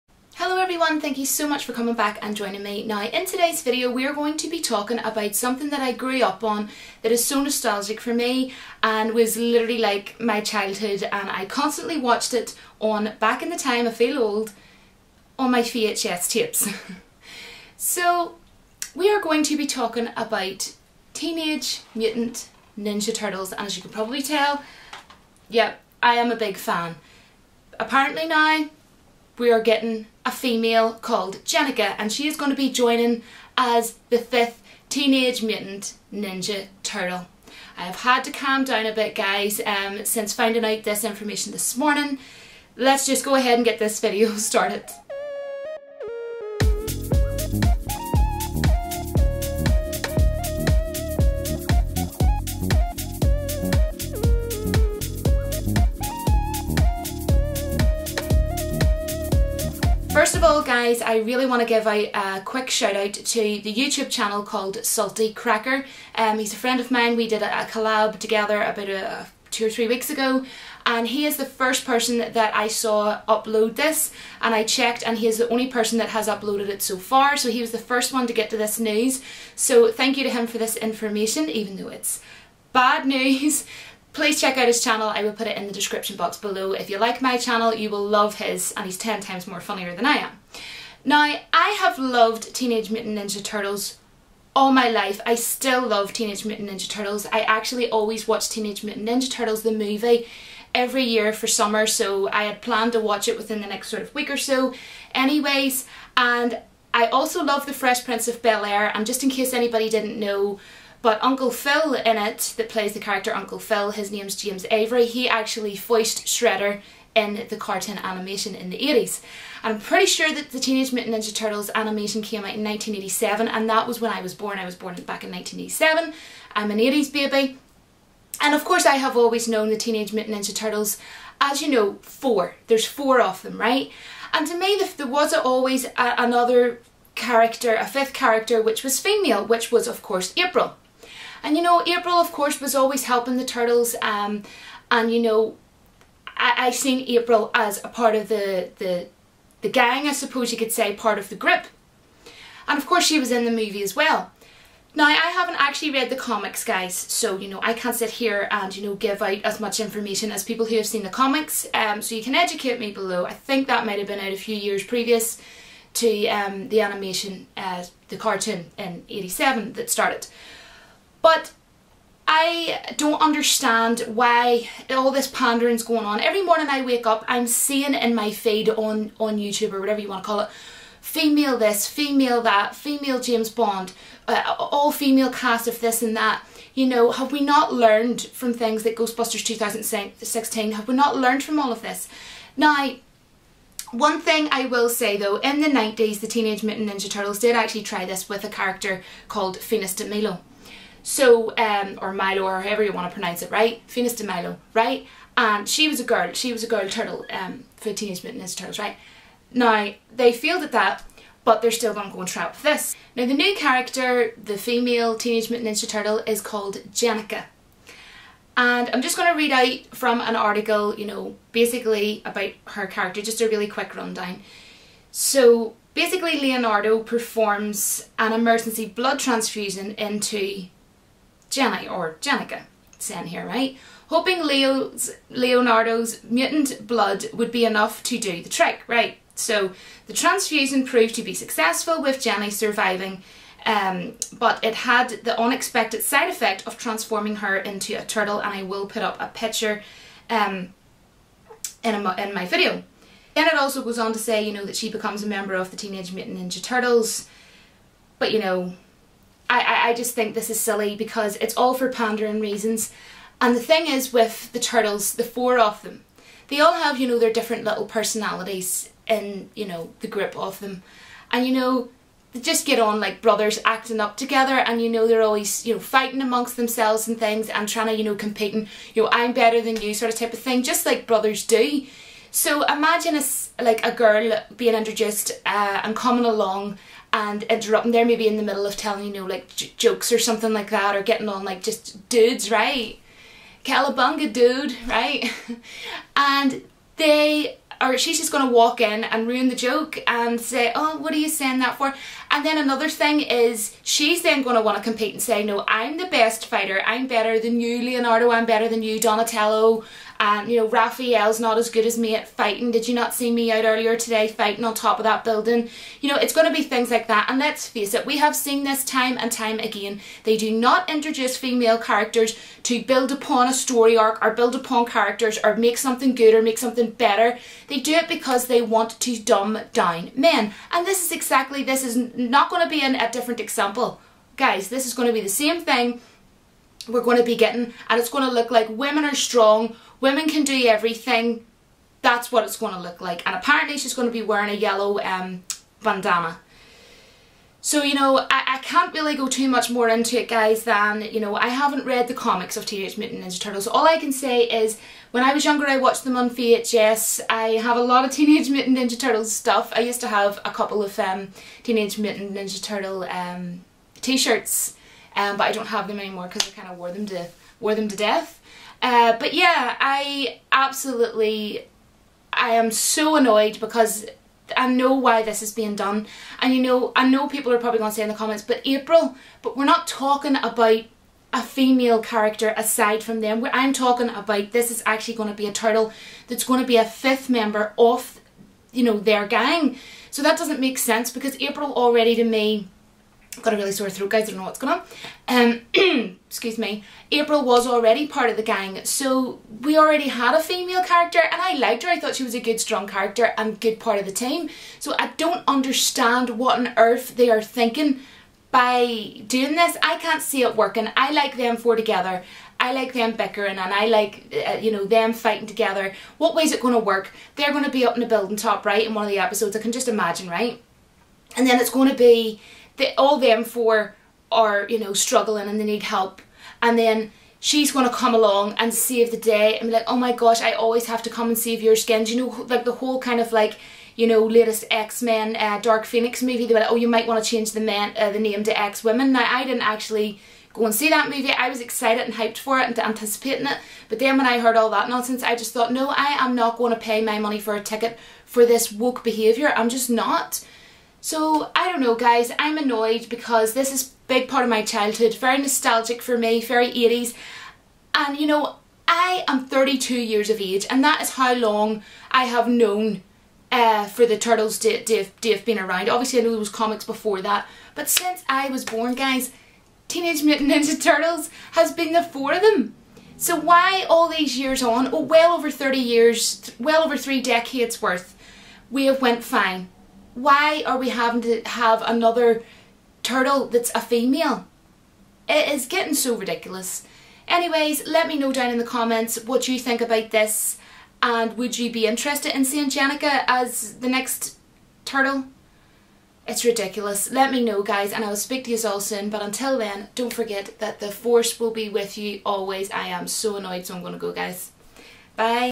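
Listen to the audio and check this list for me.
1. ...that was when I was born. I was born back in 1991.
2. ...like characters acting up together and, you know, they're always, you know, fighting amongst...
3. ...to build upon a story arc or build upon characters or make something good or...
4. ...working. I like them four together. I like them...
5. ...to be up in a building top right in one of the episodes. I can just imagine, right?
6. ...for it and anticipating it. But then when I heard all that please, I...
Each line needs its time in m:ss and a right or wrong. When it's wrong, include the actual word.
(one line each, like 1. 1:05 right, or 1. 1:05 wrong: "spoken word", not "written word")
1. 2:03 wrong: "1987", not "1991"
2. 4:33 wrong: "brothers", not "characters"
3. 5:22 right
4. 6:50 right
5. 6:57 right
6. 7:22 wrong: "nonsense", not "please".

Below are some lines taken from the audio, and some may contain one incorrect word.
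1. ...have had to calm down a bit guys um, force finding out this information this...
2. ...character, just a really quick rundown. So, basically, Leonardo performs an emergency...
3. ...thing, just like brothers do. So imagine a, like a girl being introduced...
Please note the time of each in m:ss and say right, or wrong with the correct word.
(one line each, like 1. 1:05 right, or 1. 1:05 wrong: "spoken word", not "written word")
1. 0:37 wrong: "since", not "force"
2. 3:42 right
3. 4:40 right.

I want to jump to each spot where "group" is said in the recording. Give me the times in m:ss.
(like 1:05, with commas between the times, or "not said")
2:31, 4:30.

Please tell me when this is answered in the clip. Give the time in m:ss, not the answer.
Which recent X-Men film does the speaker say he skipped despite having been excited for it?
7:15.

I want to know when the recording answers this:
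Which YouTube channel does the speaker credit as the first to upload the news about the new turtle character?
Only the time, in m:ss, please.
1:04.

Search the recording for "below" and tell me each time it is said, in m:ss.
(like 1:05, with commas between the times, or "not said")
1:26, 2:42.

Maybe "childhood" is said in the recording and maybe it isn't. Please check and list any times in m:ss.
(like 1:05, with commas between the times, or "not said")
0:10, 7:34.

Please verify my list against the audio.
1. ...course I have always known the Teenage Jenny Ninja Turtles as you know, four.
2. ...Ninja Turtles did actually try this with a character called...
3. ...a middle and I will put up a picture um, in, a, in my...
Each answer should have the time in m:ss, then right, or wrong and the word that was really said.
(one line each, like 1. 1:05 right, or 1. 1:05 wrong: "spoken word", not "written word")
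1. 2:08 wrong: "Mutant", not "Jenny"
2. 3:16 right
3. 4:07 wrong: "turtle", not "middle".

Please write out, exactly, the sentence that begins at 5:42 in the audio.
That's what it's going to look like.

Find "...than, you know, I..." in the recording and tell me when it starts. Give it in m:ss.
5:50.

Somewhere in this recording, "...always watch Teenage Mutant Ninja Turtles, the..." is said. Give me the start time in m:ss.
1:37.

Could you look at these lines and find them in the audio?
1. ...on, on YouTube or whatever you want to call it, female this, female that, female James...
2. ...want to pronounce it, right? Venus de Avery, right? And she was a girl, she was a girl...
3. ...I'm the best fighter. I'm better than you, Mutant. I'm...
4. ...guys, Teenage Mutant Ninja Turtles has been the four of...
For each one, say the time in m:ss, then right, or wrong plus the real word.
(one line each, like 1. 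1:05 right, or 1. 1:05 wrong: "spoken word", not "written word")
1. 2:58 right
2. 3:22 wrong: "Milo", not "Avery"
3. 5:05 wrong: "Leonardo", not "Mutant"
4. 7:48 right.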